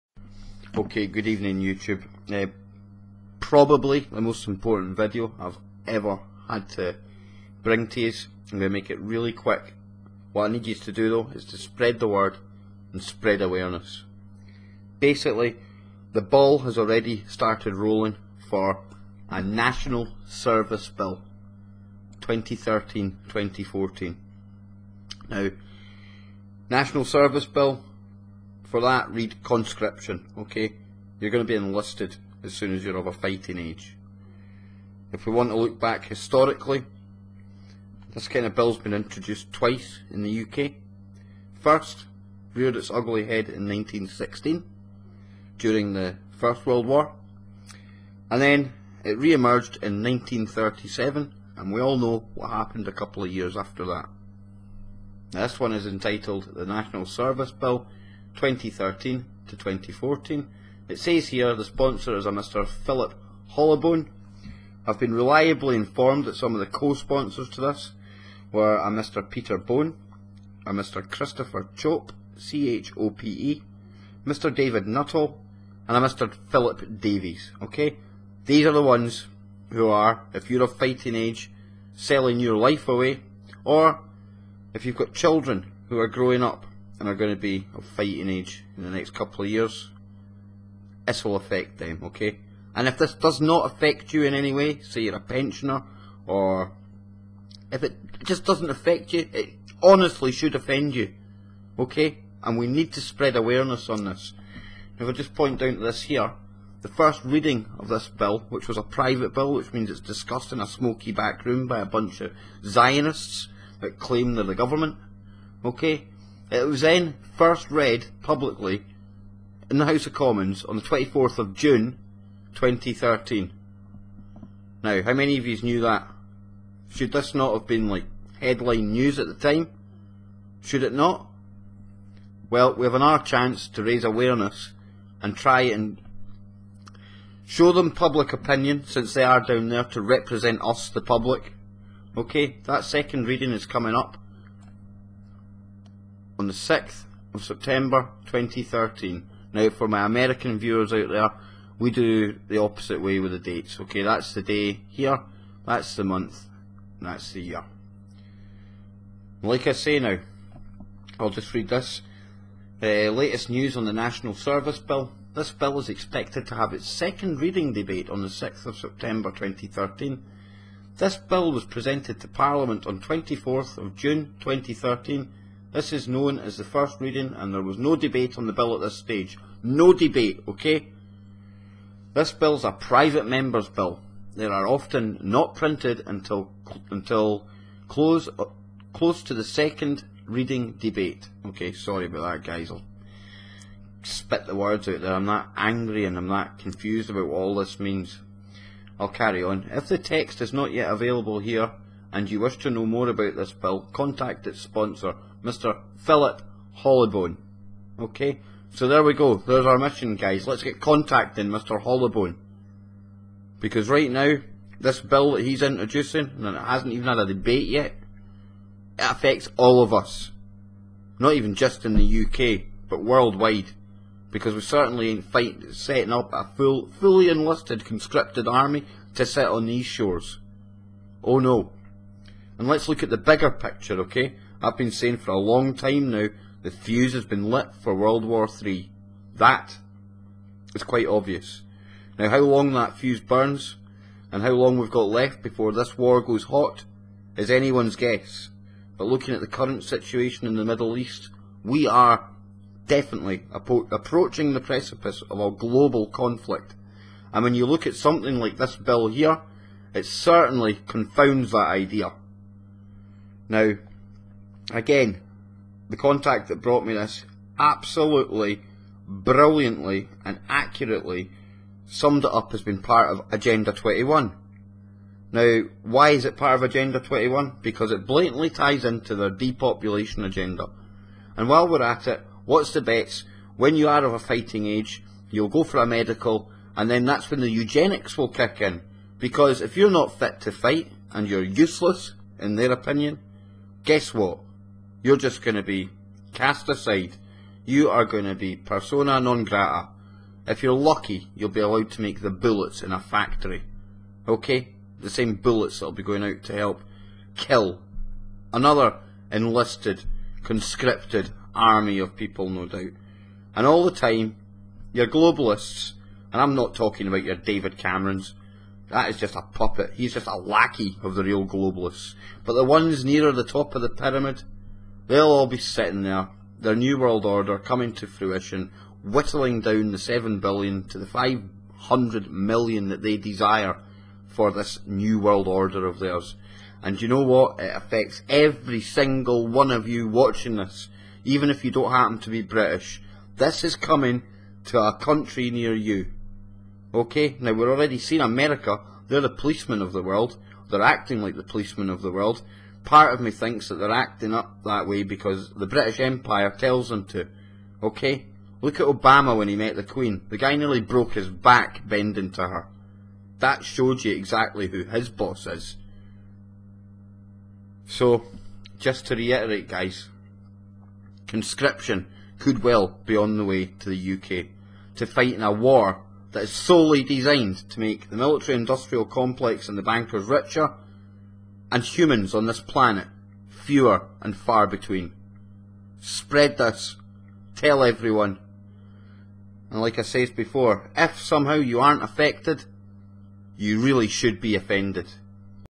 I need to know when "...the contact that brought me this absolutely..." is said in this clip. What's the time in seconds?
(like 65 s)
265 s.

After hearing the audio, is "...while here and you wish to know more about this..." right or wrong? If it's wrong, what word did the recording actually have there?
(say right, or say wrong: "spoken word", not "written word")
wrong: "available", not "while".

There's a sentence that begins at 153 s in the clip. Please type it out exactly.
Okay, that's the day here, that's the month, that's the year.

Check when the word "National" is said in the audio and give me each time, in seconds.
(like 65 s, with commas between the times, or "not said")
19 s, 26 s, 56 s, 163 s.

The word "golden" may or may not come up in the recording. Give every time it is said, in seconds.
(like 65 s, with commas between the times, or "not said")
not said.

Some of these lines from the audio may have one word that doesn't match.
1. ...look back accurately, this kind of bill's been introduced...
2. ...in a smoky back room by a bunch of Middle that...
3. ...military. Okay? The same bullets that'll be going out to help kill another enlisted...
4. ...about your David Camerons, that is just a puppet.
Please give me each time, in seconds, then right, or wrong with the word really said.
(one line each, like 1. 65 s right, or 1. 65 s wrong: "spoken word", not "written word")
1. 35 s wrong: "historically", not "accurately"
2. 110 s wrong: "Zionists", not "Middle"
3. 302 s wrong: "factory", not "military"
4. 317 s right.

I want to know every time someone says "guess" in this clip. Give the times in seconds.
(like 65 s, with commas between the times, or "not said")
247 s, 293 s.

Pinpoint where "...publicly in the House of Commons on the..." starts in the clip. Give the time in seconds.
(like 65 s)
118 s.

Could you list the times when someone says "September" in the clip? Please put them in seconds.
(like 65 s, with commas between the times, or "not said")
147 s, 168 s.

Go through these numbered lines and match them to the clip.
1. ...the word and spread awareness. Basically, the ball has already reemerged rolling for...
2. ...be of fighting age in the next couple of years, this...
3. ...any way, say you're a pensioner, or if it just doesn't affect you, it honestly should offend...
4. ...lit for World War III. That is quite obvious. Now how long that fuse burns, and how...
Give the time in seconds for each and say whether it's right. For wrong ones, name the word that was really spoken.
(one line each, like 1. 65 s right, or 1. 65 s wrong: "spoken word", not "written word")
1. 11 s wrong: "started", not "reemerged"
2. 87 s right
3. 94 s right
4. 237 s right.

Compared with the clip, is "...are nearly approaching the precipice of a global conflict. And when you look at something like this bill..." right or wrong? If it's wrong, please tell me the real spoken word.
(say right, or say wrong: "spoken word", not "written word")
wrong: "definitely", not "nearly".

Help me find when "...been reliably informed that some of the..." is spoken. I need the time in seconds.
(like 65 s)
64 s.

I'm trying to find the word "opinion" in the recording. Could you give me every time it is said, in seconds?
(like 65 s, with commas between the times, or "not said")
138 s, 292 s.